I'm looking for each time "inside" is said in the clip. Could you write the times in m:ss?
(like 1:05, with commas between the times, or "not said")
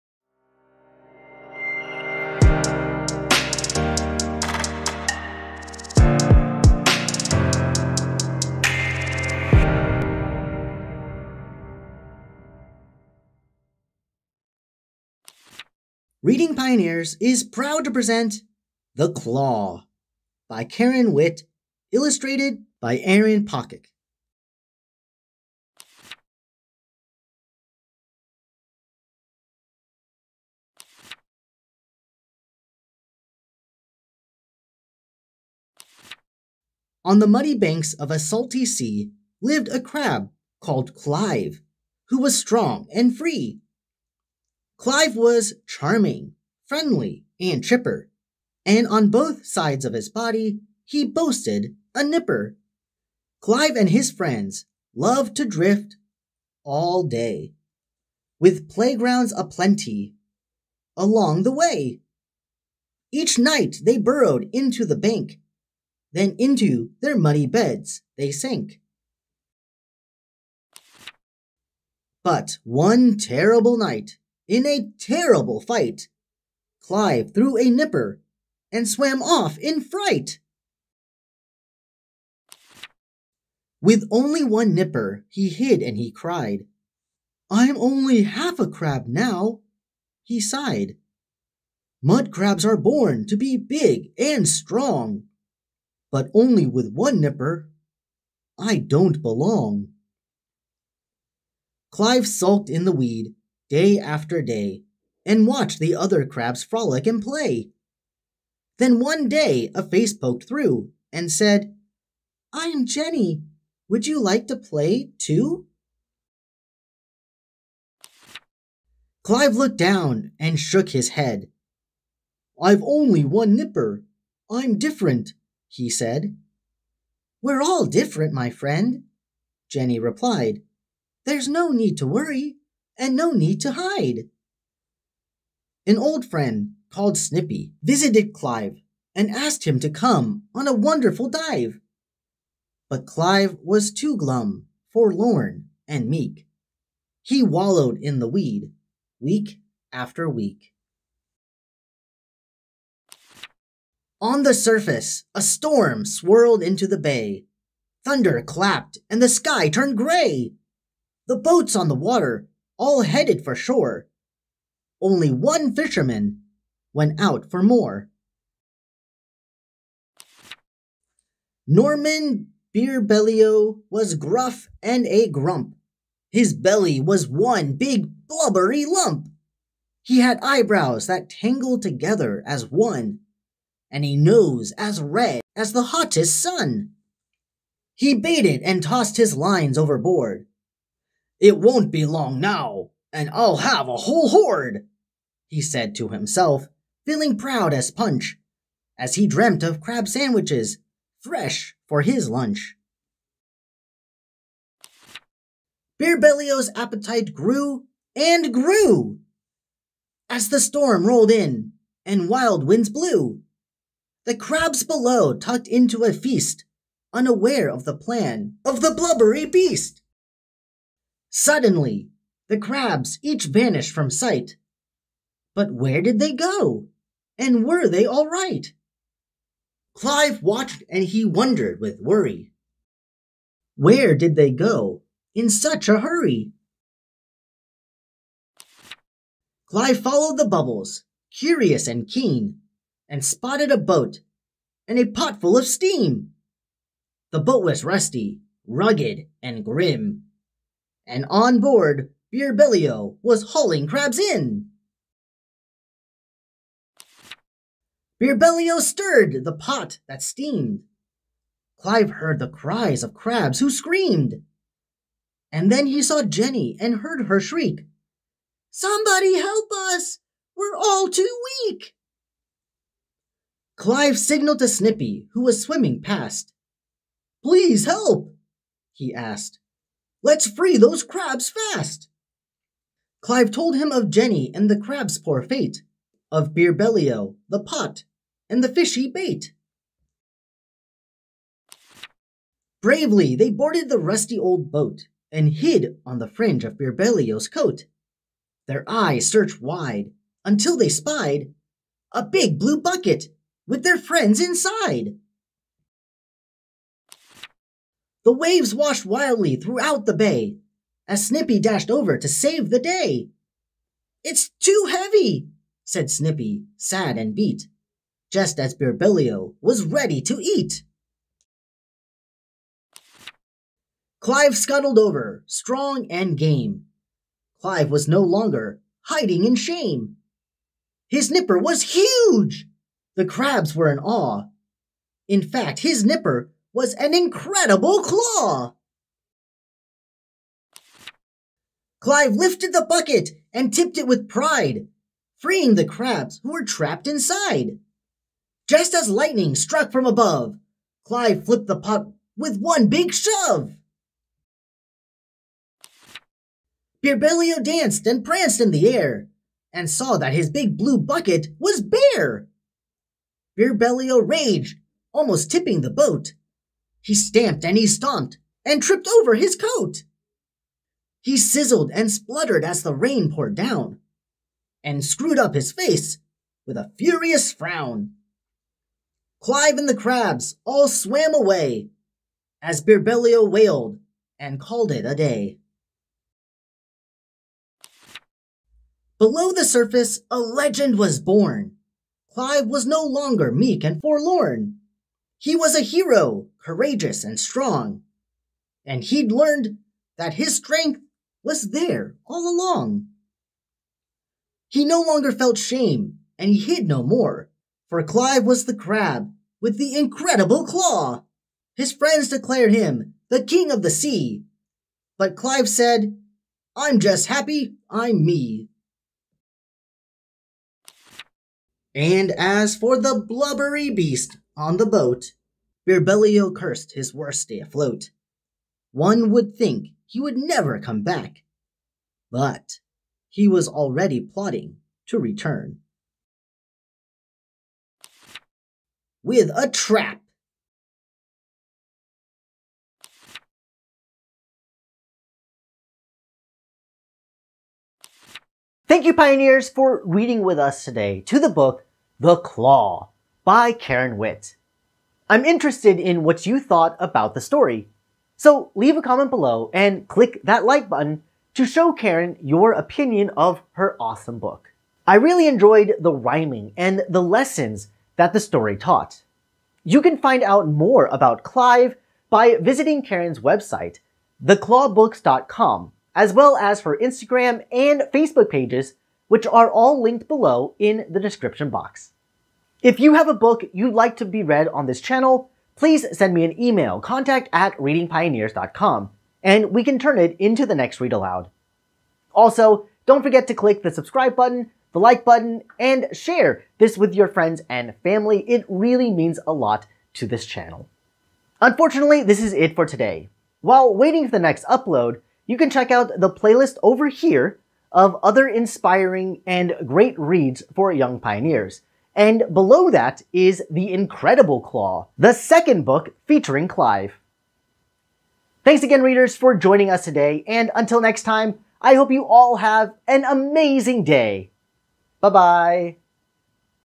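5:04, 5:47.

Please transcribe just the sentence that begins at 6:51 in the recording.
His friends declared him the king of the sea, but Clive said, I'm just happy I'm me.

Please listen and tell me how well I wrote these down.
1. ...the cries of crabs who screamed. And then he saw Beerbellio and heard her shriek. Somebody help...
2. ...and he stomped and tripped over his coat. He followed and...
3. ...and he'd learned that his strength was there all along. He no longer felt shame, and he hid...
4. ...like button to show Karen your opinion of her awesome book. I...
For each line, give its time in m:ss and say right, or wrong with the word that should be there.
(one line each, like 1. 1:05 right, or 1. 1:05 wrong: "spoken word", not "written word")
1. 4:22 wrong: "Jenny", not "Beerbellio"
2. 6:07 wrong: "sizzled", not "followed"
3. 6:38 right
4. 7:40 right.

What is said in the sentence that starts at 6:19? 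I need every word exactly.
Clive and the crabs all swam away as Beerbellio wailed and called it a day.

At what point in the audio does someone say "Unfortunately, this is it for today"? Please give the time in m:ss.
8:21.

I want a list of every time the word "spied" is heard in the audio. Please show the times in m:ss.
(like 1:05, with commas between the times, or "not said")
5:00.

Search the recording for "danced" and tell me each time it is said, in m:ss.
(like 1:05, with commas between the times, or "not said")
5:57.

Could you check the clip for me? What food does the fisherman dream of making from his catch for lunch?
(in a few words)
crab sandwiches.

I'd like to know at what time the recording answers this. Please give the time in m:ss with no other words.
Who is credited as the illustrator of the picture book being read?
0:22.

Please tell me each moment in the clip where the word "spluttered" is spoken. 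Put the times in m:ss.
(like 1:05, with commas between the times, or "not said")
6:12.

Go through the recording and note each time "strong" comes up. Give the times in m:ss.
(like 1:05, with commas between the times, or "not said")
0:42, 1:34, 5:25, 6:37.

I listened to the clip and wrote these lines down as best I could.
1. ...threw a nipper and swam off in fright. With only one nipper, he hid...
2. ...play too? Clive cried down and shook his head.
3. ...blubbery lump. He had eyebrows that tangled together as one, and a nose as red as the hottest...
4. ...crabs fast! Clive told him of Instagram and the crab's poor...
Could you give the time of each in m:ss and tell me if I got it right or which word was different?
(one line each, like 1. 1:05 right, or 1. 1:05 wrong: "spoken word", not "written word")
1. 1:17 right
2. 1:54 wrong: "looked", not "cried"
3. 2:58 right
4. 4:41 wrong: "Jenny", not "Instagram".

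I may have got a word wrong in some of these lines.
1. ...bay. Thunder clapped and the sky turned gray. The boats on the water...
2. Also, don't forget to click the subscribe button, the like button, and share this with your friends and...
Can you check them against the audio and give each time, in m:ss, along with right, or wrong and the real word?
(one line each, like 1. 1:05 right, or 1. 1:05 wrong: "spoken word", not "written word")
1. 2:36 right
2. 8:12 right.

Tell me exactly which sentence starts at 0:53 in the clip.
Clive and his friends loved to drift all day, with playgrounds aplenty along the way.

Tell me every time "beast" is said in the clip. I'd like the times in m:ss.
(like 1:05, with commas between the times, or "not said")
3:39, 7:03.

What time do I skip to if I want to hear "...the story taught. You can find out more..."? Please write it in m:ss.
7:48.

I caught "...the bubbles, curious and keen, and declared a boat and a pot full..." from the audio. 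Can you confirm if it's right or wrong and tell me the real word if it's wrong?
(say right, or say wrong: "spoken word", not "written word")
wrong: "spotted", not "declared".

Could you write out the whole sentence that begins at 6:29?
Below the surface, a legend was born.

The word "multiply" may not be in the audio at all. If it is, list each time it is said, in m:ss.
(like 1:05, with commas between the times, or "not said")
not said.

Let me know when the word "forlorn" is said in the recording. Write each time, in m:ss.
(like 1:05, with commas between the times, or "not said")
2:24, 6:34.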